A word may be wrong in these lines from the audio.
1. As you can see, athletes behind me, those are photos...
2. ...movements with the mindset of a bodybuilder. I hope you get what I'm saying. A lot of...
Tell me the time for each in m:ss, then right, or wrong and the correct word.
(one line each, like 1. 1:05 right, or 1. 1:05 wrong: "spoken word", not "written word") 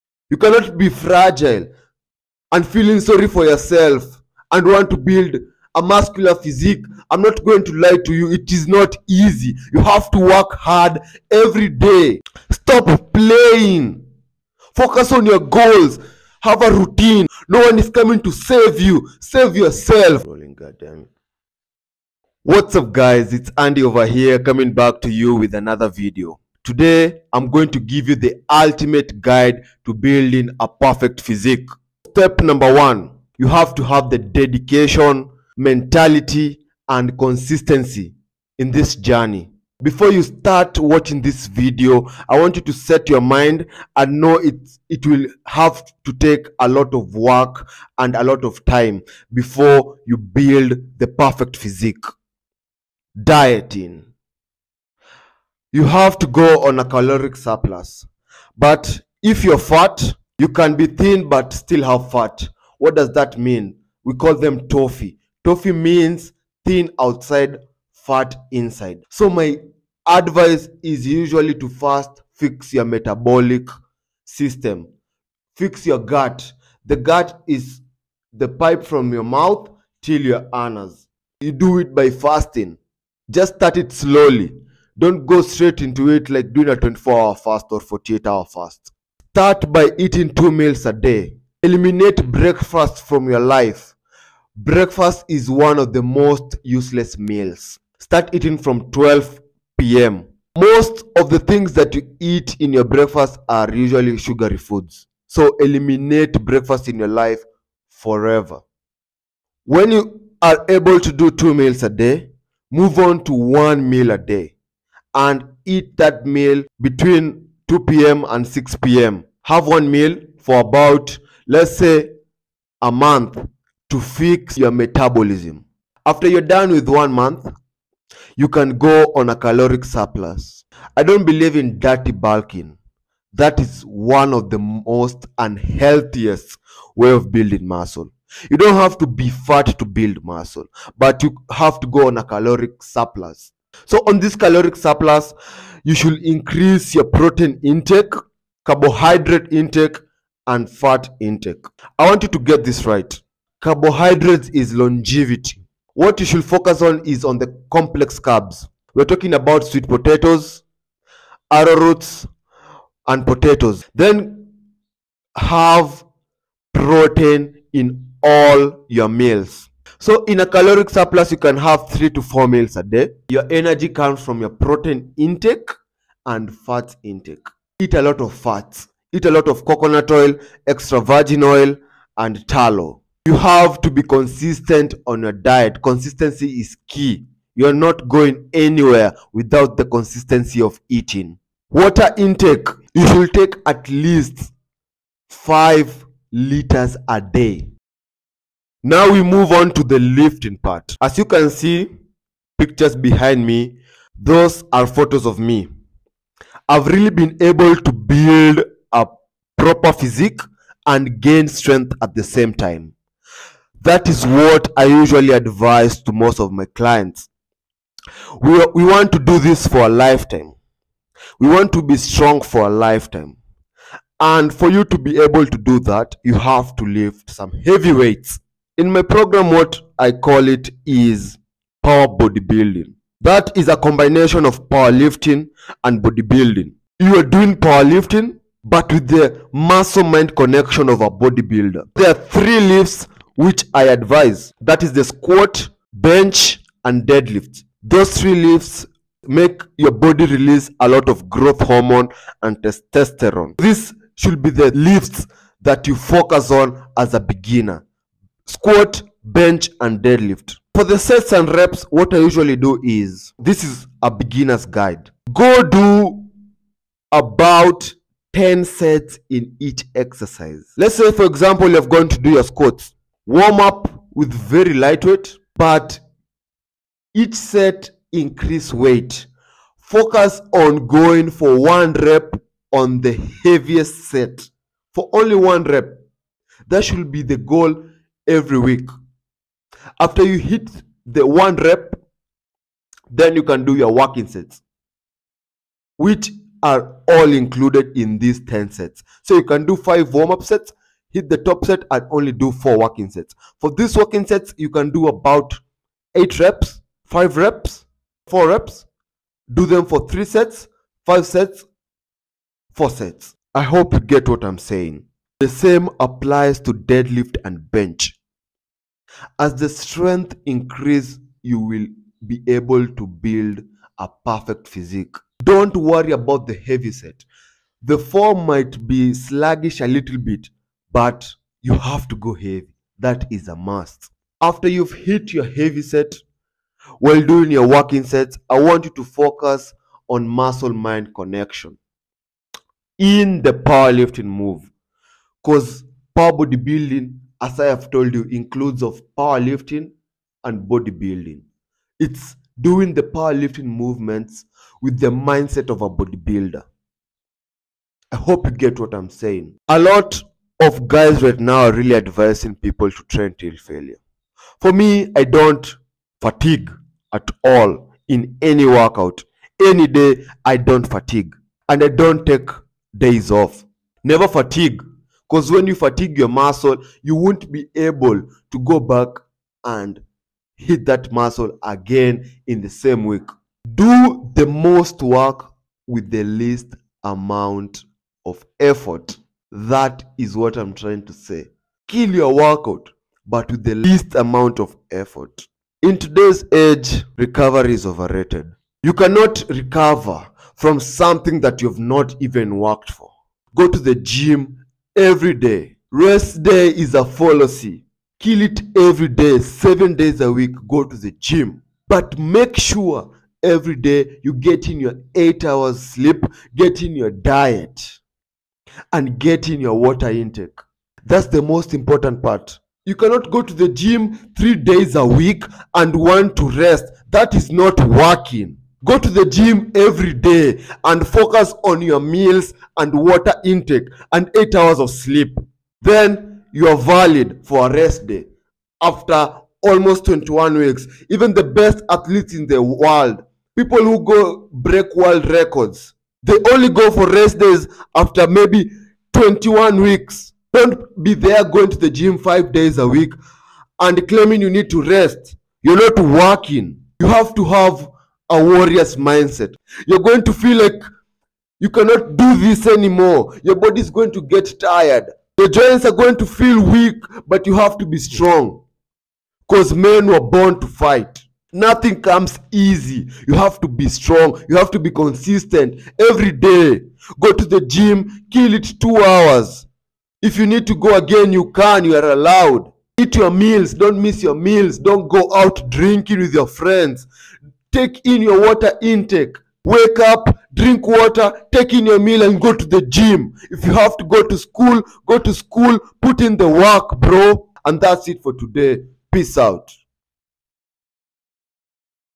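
1. 3:21 wrong: "pictures", not "athletes"
2. 5:53 right.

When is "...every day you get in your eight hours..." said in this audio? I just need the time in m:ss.
6:53.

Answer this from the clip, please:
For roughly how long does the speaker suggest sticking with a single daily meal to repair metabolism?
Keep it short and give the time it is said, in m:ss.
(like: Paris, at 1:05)
a month, at 2:02.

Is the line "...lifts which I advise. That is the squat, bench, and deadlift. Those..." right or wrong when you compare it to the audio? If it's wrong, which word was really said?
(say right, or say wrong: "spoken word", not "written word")
right.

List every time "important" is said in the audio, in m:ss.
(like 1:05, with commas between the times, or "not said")
7:01.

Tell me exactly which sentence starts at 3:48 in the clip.
In my program, what I call it is power bodybuilding.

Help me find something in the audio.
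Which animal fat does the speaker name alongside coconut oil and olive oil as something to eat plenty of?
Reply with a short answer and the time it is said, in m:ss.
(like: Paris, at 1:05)
tallow, at 3:02.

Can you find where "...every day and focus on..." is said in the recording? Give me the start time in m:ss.
7:09.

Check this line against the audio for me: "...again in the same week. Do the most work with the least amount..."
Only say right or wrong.
right.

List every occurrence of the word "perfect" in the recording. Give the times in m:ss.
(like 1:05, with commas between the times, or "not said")
0:30, 0:51, 5:24.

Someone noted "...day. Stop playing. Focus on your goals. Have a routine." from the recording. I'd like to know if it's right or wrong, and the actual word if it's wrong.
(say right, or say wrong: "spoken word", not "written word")
right.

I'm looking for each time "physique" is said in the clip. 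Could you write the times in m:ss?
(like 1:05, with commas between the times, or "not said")
0:06, 0:31, 0:51, 3:29, 5:24.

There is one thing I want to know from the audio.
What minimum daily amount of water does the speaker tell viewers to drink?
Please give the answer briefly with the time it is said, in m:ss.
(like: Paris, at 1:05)
5 liters, at 3:15.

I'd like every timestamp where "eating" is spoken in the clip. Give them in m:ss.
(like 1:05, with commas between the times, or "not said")
1:29, 1:38, 3:10.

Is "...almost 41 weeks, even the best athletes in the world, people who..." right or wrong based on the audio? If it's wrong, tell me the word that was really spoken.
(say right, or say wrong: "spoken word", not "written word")
wrong: "21", not "41".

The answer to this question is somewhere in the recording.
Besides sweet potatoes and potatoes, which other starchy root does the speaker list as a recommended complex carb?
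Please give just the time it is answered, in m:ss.
2:41.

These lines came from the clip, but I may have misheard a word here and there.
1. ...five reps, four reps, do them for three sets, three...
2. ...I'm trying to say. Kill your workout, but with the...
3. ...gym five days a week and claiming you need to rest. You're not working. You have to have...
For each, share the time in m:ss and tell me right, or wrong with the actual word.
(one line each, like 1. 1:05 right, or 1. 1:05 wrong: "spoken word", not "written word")
1. 5:07 wrong: "five", not "three"
2. 6:30 right
3. 7:31 right.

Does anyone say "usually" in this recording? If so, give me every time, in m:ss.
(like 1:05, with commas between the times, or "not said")
1:11, 1:43, 3:34, 4:22.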